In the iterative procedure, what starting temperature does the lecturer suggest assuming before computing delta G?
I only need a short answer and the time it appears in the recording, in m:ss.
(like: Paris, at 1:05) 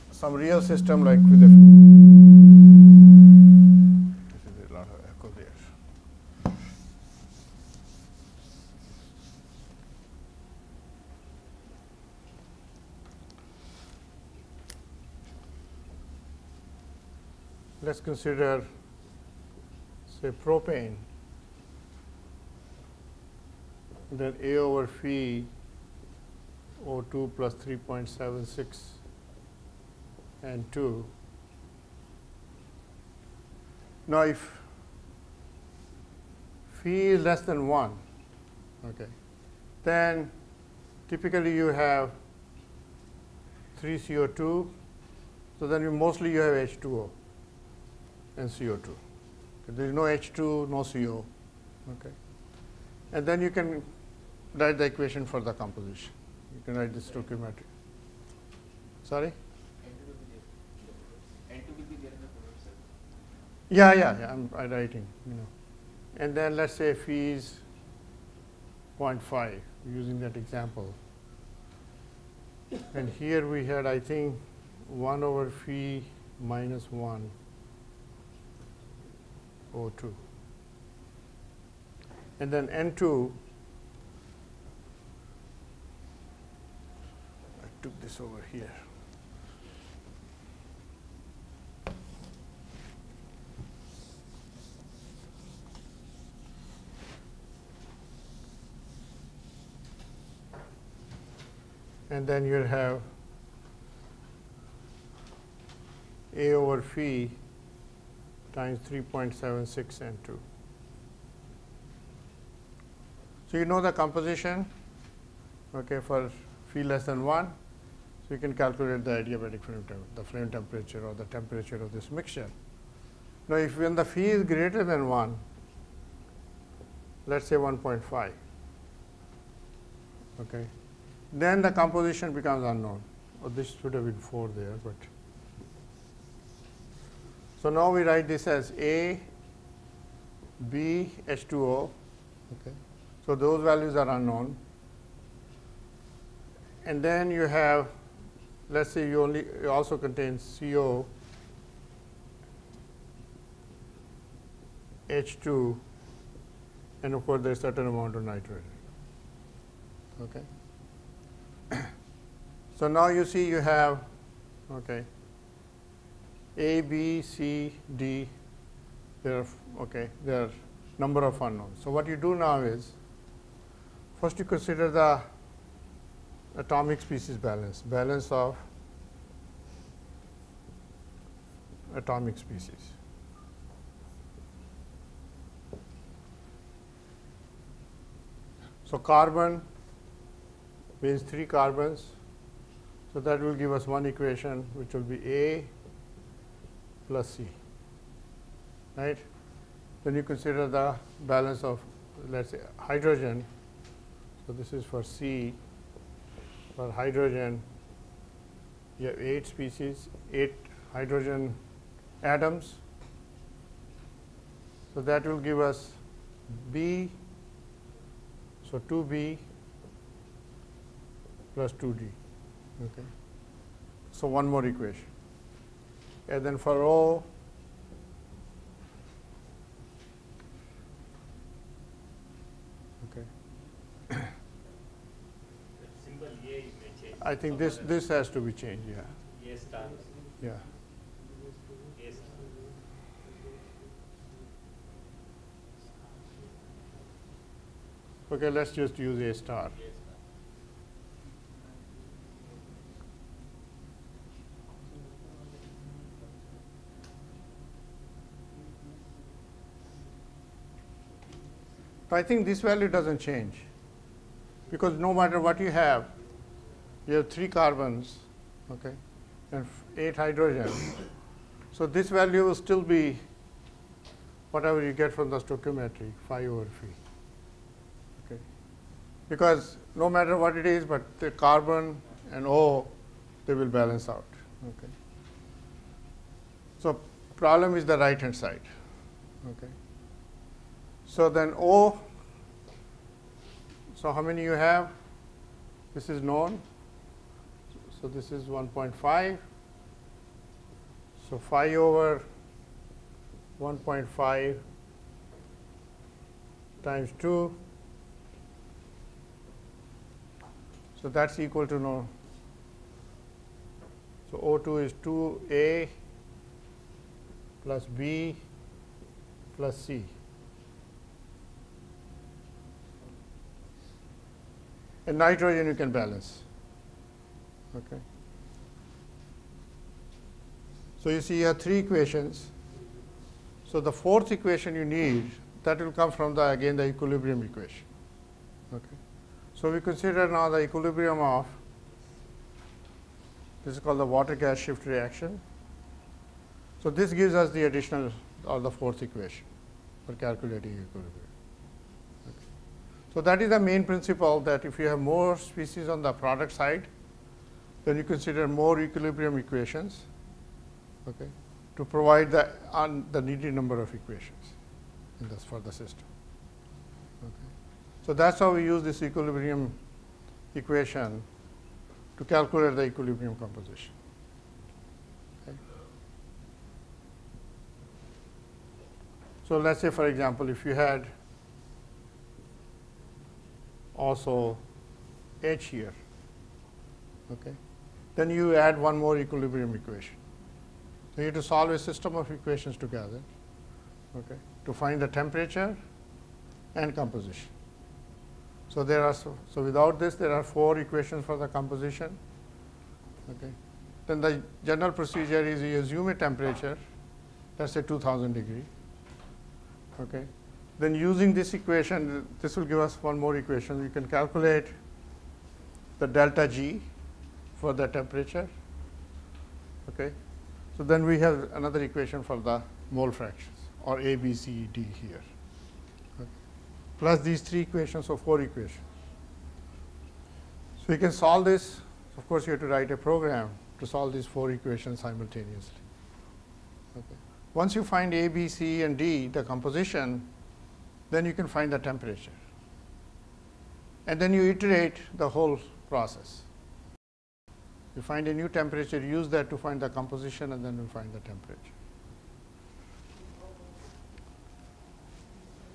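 2000 degrees, at 6:47.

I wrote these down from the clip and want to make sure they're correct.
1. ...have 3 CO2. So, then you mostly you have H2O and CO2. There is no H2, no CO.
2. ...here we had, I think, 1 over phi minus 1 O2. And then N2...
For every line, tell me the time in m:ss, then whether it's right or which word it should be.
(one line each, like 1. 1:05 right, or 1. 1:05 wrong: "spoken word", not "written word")
1. 0:41 right
2. 1:13 right.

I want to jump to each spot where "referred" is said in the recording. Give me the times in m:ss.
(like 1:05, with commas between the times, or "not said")
not said.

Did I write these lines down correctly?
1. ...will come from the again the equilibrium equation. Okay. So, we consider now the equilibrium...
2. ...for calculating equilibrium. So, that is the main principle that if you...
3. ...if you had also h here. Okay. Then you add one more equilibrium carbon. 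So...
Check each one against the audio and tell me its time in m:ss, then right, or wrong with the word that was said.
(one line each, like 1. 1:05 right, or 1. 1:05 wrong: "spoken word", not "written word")
1. 5:35 right
2. 5:50 right
3. 6:20 wrong: "equation", not "carbon".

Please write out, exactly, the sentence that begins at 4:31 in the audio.
So, this value will still be whatever you get from the stoichiometry phi over phi okay.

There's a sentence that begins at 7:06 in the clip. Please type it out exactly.
plus these three equations, so four equations.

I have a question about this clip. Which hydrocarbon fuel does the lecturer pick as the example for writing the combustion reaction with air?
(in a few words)
Propane.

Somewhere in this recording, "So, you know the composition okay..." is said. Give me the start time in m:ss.
1:53.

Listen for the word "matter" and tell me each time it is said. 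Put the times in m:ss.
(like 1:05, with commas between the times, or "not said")
4:25, 4:40.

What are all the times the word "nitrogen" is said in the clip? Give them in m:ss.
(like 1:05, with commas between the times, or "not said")
2:38, 5:25.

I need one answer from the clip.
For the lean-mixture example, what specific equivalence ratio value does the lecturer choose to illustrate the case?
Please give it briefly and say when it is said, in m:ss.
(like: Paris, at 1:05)
0.5, at 1:09.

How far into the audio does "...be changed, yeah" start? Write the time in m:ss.
3:58.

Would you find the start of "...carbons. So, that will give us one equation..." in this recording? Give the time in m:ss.
3:11.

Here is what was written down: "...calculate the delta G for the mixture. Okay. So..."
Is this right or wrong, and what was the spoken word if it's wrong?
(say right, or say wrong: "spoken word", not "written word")
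wrong: "temperature", not "mixture".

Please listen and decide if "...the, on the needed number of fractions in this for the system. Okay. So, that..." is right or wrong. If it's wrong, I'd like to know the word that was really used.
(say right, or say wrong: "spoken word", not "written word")
wrong: "equations", not "fractions".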